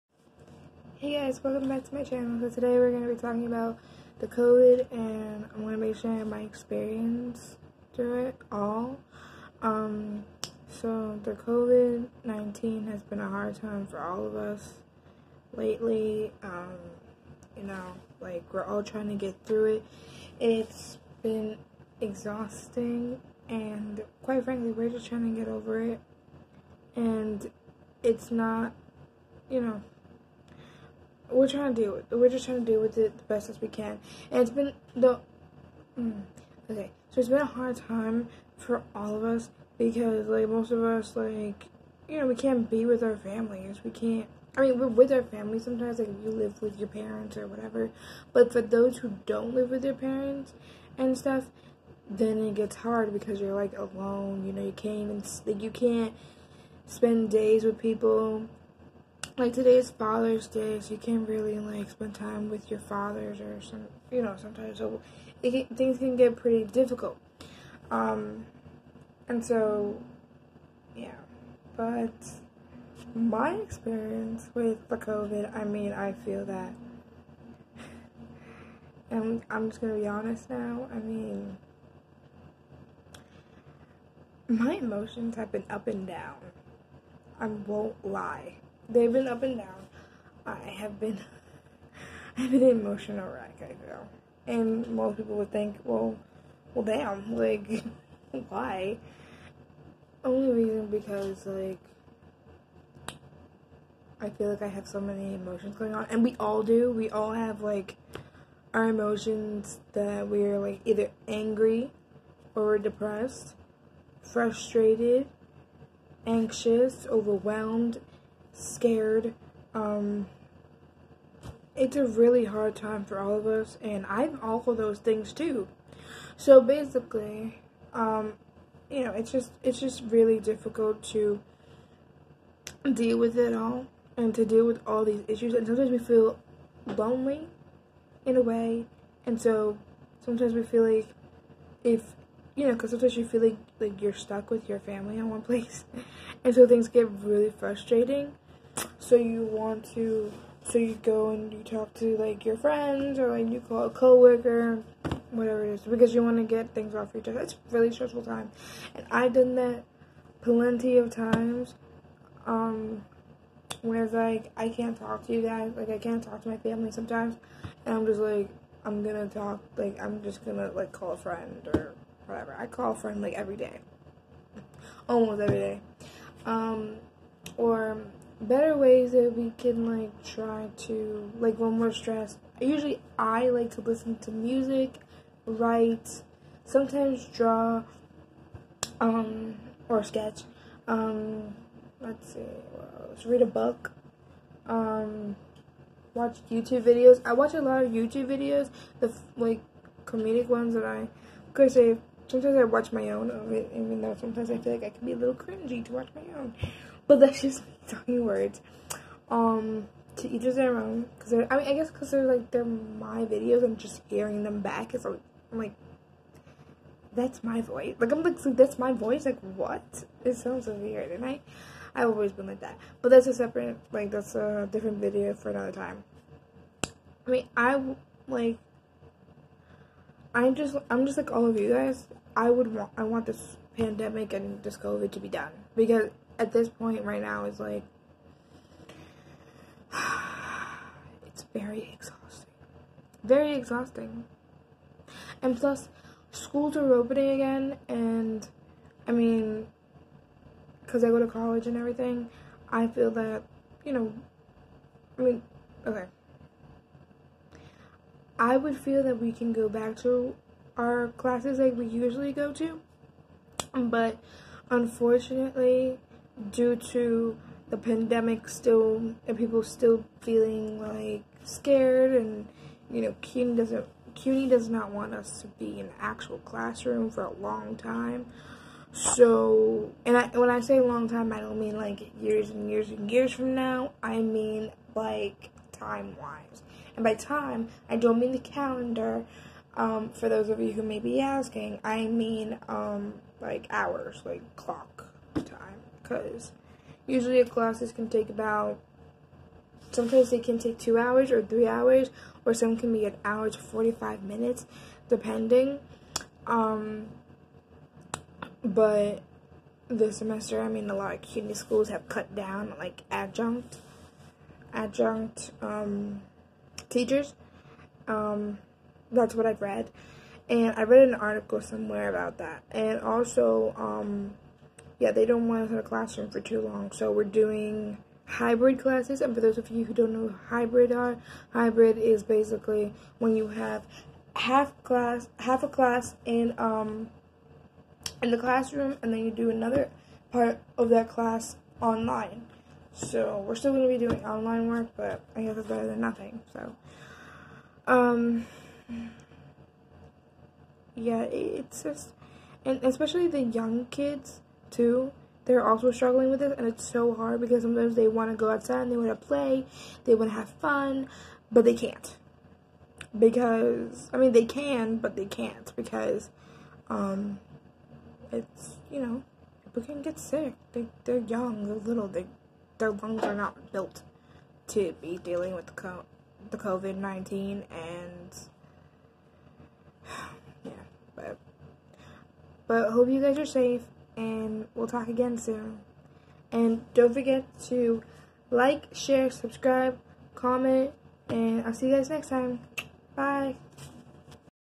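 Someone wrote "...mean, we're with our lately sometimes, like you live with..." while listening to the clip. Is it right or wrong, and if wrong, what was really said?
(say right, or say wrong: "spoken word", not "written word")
wrong: "family", not "lately".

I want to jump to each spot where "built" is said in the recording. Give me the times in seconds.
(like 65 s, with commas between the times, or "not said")
373 s.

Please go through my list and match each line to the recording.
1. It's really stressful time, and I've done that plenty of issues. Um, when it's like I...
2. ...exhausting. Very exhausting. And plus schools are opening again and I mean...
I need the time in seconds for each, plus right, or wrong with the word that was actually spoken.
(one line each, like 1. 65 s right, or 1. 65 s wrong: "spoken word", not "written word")
1. 157 s wrong: "times", not "issues"
2. 241 s right.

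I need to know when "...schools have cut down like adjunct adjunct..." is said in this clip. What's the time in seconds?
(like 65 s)
311 s.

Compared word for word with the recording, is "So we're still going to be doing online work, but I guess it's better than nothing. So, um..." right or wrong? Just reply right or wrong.
right.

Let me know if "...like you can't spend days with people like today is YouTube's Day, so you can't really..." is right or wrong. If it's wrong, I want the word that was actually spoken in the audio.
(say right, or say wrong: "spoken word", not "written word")
wrong: "Father", not "YouTube".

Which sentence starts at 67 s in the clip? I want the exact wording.
Um, and so, yeah, but my experience with the COVID, I mean, I feel that.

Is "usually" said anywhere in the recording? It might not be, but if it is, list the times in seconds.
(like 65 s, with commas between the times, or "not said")
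182 s, 261 s, 297 s.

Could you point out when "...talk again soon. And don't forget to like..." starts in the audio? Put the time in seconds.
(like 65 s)
384 s.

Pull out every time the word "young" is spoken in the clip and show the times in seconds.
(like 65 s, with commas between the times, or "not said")
353 s, 371 s.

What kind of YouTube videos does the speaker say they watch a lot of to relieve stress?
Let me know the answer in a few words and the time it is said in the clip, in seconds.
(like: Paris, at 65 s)
comedic ones, at 200 s.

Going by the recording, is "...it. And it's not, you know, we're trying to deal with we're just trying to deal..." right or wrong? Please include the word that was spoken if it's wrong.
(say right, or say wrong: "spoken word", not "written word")
right.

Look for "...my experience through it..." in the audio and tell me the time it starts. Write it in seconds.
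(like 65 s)
6 s.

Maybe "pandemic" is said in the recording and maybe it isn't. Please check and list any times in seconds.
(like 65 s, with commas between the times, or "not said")
233 s, 267 s.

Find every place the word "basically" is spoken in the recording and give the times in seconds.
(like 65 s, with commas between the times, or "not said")
126 s, 332 s.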